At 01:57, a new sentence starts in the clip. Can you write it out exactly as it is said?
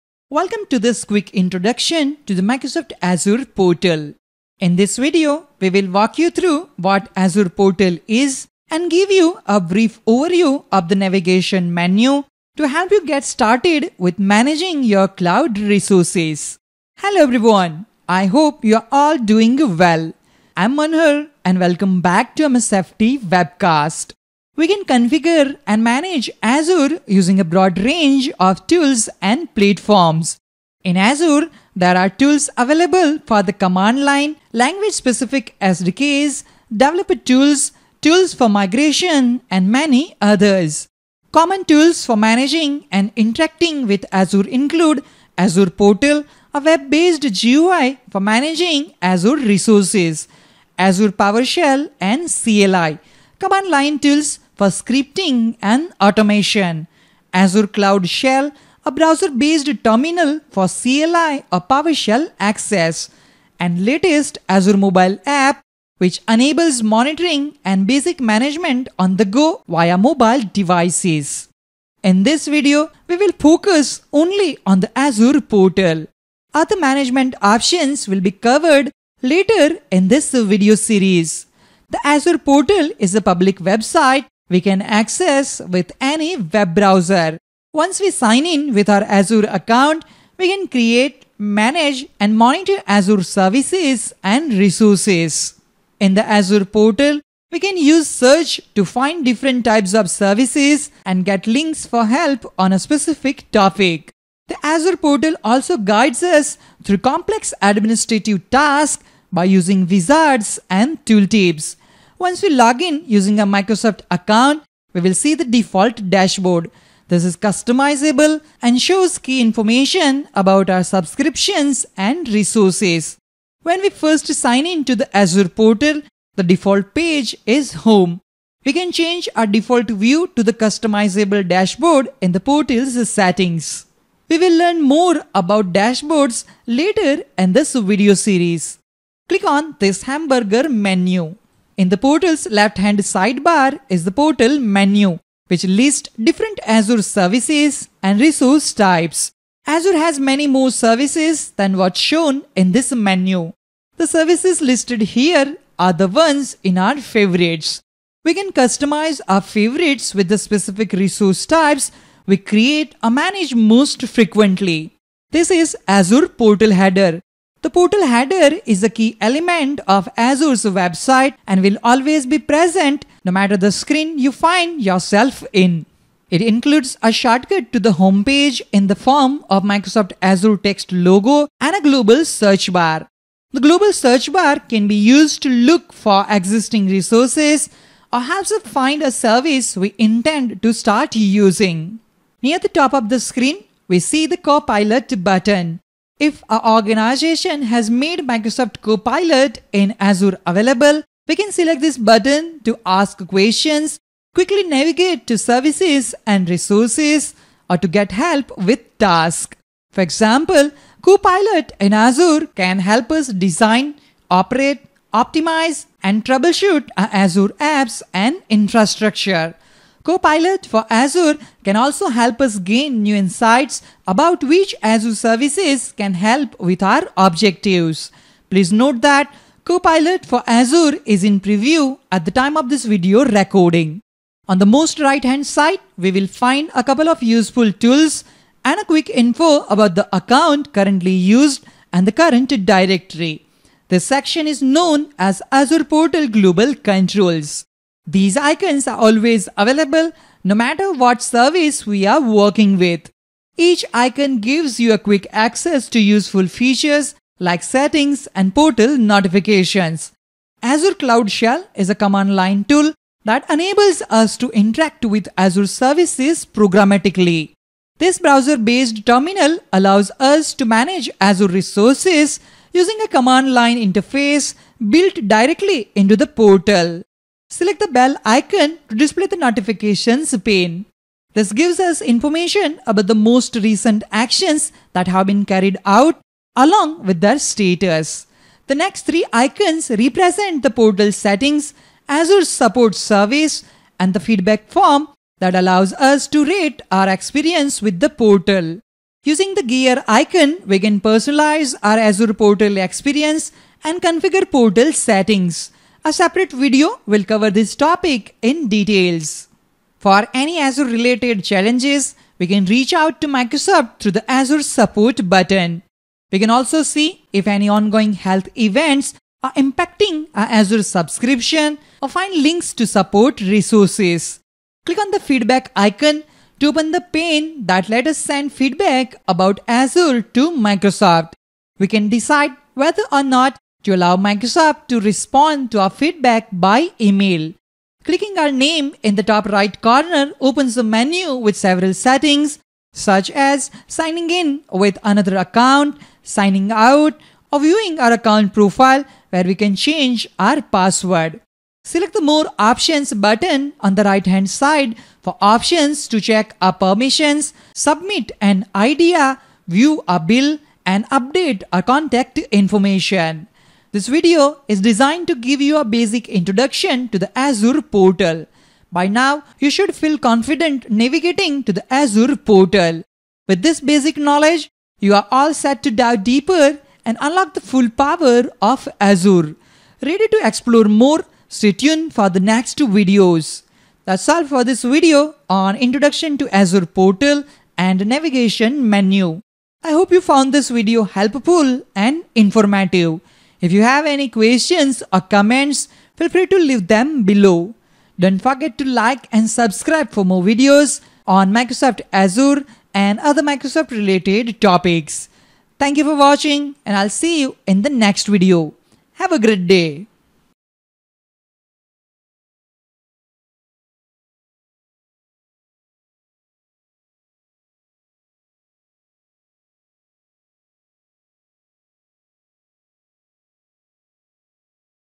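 This is customizable and shows key information about our subscriptions and resources.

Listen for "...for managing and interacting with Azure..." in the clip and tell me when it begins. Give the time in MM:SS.
00:42.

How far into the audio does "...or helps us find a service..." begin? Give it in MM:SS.
03:08.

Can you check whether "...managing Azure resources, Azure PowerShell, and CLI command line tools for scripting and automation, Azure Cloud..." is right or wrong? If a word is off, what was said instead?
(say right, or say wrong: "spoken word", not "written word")
right.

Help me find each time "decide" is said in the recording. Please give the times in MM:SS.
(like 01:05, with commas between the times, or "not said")
05:32.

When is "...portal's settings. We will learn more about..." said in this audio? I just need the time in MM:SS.
02:12.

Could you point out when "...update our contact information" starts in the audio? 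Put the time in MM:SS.
06:01.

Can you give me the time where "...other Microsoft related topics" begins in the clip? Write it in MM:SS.
06:43.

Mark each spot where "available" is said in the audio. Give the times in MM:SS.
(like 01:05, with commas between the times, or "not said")
00:32, 03:20, 04:09.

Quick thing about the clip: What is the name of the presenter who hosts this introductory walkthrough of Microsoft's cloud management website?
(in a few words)
Manhur.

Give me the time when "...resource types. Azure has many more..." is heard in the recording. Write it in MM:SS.
02:28.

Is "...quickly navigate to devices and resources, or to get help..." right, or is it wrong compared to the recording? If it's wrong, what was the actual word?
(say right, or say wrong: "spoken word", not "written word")
wrong: "services", not "devices".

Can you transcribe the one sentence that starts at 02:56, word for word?
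It includes a shortcut to the homepage in the form of Microsoft Azure text logo and a global search bar.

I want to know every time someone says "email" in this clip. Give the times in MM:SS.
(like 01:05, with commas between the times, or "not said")
05:36.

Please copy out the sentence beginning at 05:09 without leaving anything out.
For any Azure related challenges, we can reach out to Microsoft through the Azure support button.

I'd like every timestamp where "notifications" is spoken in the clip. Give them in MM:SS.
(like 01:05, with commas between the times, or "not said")
04:18, 04:39.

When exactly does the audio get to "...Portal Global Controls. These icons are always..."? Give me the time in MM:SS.
04:05.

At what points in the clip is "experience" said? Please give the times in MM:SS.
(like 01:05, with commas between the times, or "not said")
04:57, 05:02.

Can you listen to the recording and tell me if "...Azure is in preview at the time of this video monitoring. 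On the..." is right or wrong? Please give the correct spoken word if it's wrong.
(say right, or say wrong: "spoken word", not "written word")
wrong: "recording", not "monitoring".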